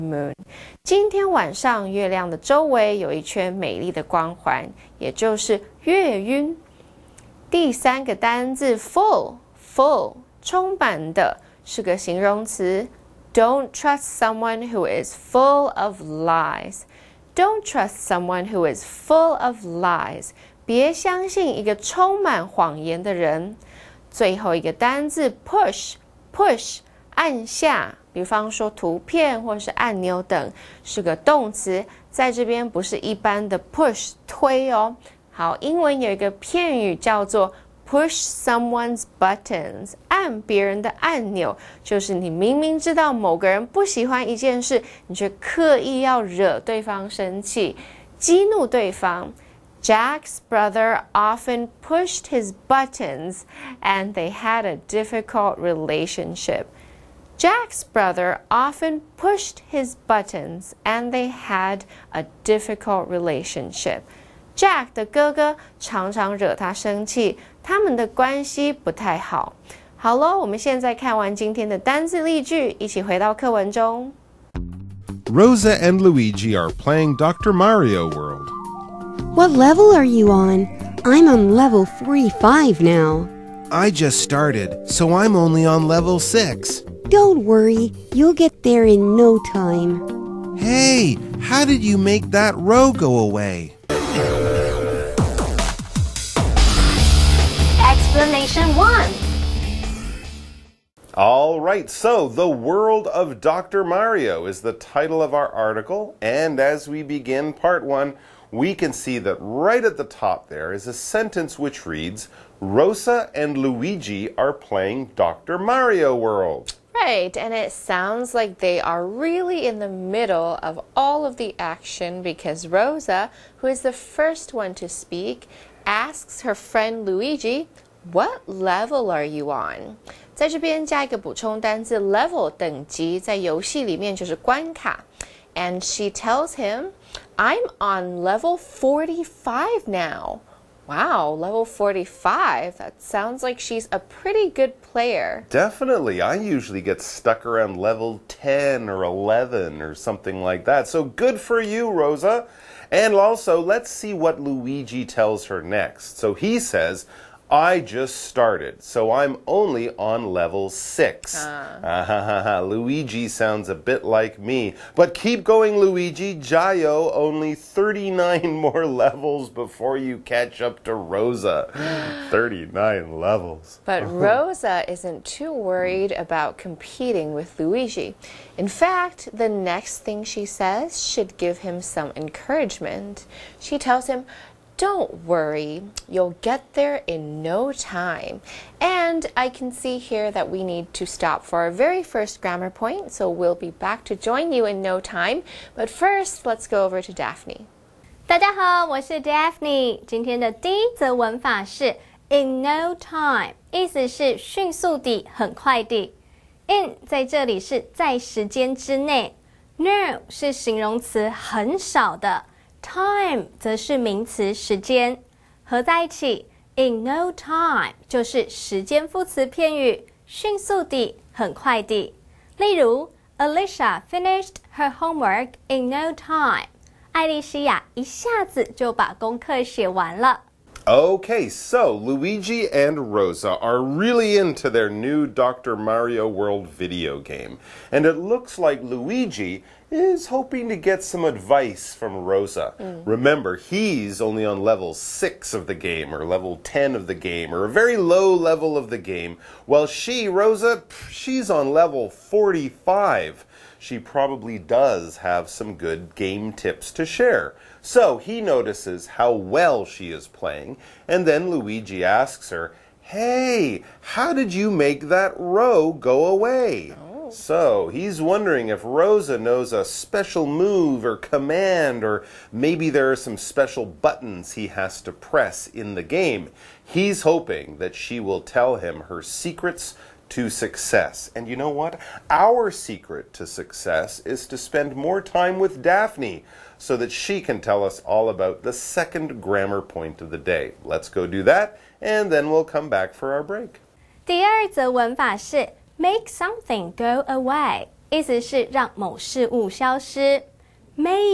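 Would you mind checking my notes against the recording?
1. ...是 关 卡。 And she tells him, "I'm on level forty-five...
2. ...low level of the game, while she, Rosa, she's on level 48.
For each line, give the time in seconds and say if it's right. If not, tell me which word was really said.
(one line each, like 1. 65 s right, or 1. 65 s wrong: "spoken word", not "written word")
1. 134 s right
2. 247 s wrong: "45", not "48".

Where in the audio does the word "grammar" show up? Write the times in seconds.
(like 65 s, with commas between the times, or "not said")
192 s, 289 s.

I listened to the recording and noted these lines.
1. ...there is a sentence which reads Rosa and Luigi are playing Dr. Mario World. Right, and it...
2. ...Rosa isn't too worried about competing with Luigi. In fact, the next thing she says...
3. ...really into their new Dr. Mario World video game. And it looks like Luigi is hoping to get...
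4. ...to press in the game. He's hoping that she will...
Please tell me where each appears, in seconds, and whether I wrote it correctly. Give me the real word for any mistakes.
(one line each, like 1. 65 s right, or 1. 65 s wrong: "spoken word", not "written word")
1. 110 s right
2. 174 s right
3. 233 s right
4. 275 s right.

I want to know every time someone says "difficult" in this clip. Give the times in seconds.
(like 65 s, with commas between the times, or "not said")
54 s, 62 s.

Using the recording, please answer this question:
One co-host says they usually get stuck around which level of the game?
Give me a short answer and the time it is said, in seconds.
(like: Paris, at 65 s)
10 or 11, at 147 s.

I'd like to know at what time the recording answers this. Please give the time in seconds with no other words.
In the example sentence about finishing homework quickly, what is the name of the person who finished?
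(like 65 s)
223 s.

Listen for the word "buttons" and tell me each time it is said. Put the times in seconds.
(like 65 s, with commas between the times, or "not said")
39 s, 52 s, 60 s, 273 s.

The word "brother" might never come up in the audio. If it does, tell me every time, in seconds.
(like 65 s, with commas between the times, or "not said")
50 s, 57 s.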